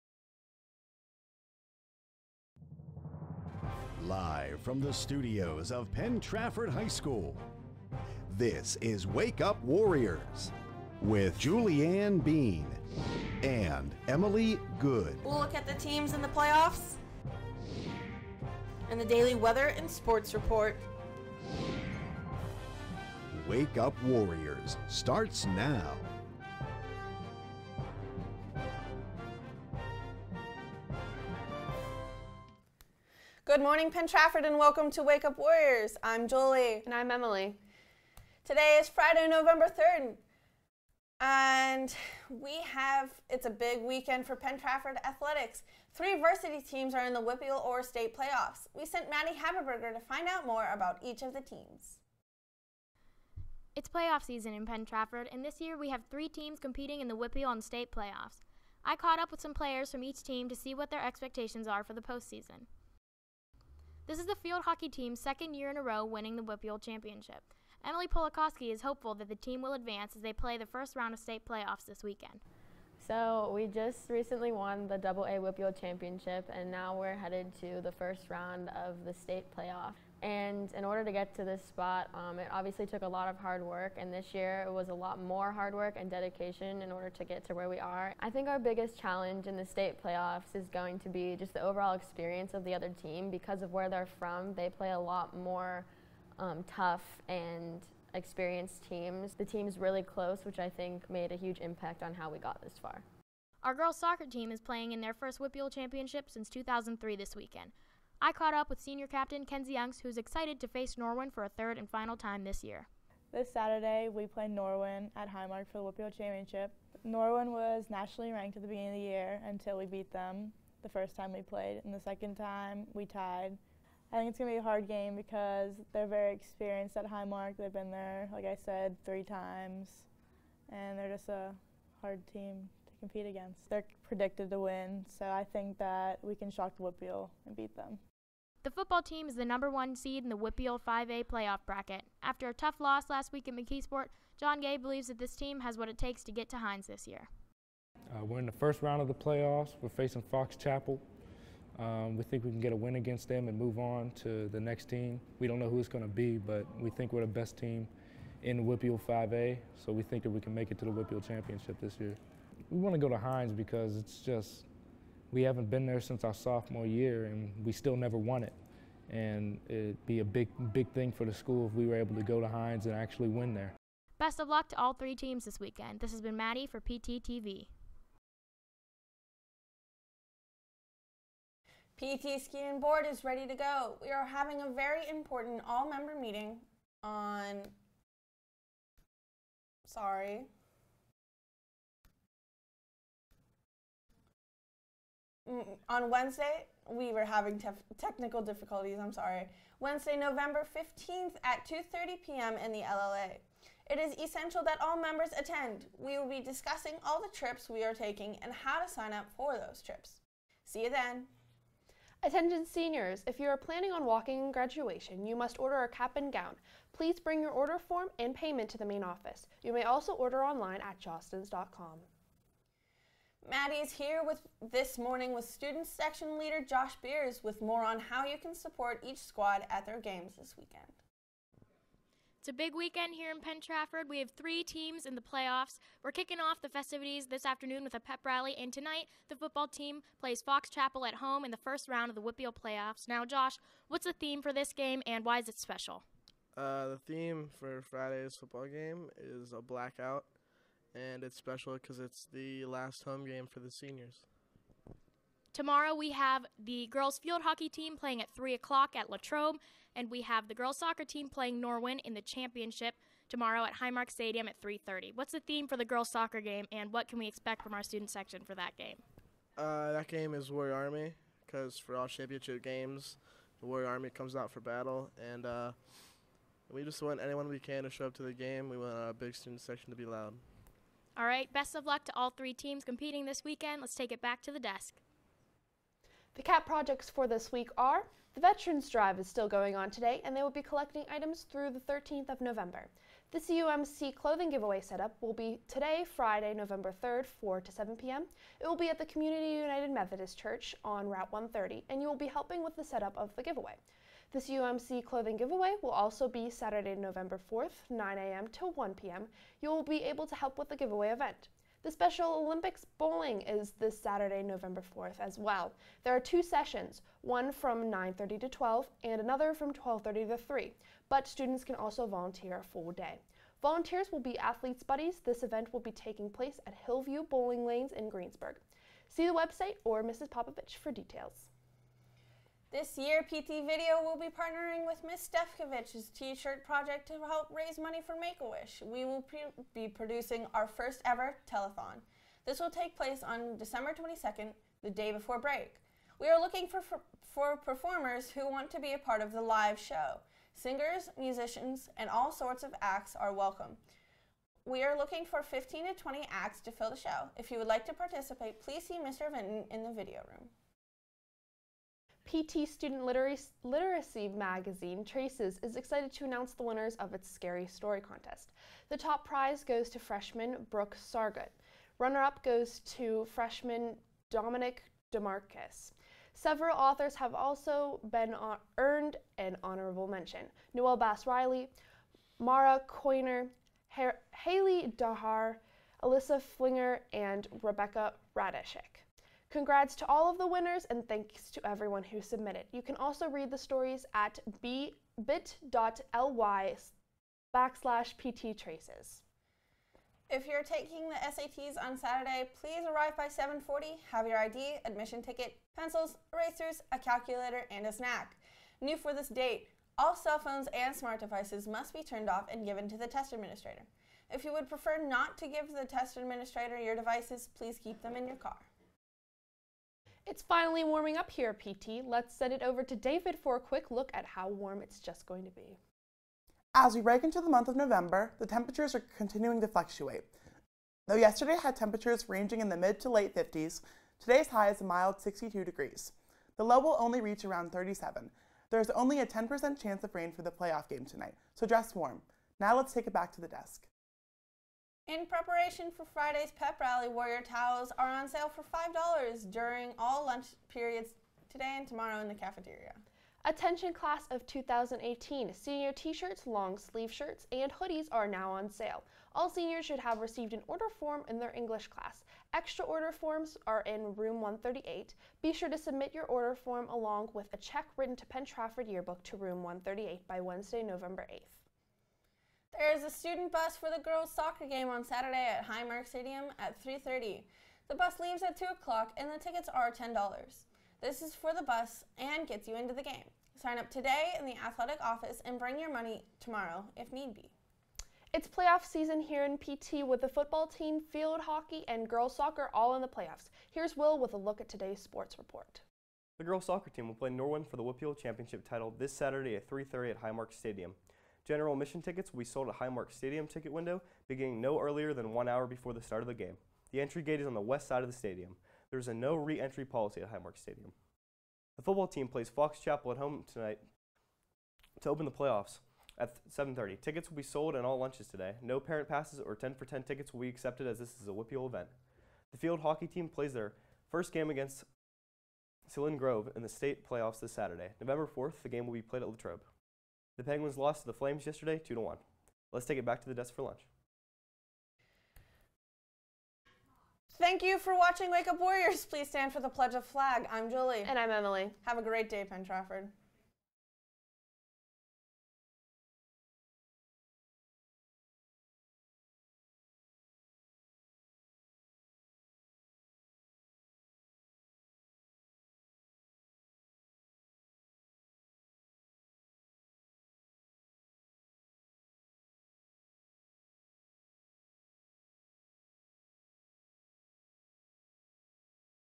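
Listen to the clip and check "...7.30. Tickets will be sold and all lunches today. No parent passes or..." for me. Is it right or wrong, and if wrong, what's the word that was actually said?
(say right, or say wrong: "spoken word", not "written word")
right.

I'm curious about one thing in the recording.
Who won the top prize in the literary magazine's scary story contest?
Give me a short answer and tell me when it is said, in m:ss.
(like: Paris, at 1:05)
Brooke Sargut, at 6:10.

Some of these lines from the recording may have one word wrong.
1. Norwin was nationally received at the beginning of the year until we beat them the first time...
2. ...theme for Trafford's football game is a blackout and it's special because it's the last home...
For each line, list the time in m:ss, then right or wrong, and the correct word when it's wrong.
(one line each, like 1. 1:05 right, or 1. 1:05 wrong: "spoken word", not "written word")
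1. 1:57 wrong: "ranked", not "received"
2. 4:07 wrong: "Friday", not "Trafford".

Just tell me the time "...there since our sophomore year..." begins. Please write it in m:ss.
2:45.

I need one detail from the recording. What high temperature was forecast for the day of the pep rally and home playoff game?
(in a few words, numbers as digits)
62 degrees.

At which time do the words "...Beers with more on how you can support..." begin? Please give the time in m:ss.
3:47.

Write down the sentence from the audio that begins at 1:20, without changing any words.
And in order to get to this spot, um, it obviously took a lot of hard work.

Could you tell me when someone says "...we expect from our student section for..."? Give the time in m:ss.
4:27.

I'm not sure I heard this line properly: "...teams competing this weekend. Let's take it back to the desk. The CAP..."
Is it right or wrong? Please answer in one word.
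right.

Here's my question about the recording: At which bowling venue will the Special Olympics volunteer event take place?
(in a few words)
Hillview Bowling Lanes.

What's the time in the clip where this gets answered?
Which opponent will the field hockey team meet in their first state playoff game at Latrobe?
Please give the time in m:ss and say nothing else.
8:45.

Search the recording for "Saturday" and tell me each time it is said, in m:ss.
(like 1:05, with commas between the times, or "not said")
1:53, 5:06, 5:13, 6:41, 7:55, 8:19, 8:47.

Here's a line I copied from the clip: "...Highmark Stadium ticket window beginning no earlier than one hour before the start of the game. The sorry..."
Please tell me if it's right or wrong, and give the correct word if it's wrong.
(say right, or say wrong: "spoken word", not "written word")
wrong: "entry", not "sorry".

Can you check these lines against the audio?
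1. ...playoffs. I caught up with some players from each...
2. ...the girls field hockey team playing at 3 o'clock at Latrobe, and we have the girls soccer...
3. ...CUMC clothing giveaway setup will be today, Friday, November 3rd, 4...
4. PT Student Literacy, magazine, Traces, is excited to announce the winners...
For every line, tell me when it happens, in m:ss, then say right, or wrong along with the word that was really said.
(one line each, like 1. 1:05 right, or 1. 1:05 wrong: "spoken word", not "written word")
1. 0:57 right
2. 4:16 right
3. 4:53 right
4. 6:02 right.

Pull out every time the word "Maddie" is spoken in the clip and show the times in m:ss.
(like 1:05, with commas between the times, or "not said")
0:49, 2:56, 3:43.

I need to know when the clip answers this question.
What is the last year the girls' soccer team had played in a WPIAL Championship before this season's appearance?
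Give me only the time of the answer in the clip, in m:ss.
1:46.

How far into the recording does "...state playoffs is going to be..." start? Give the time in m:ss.
1:29.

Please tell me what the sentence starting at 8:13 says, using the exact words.
Here's Will with a look at today's sports report.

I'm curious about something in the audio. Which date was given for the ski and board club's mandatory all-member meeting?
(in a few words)
November 15th.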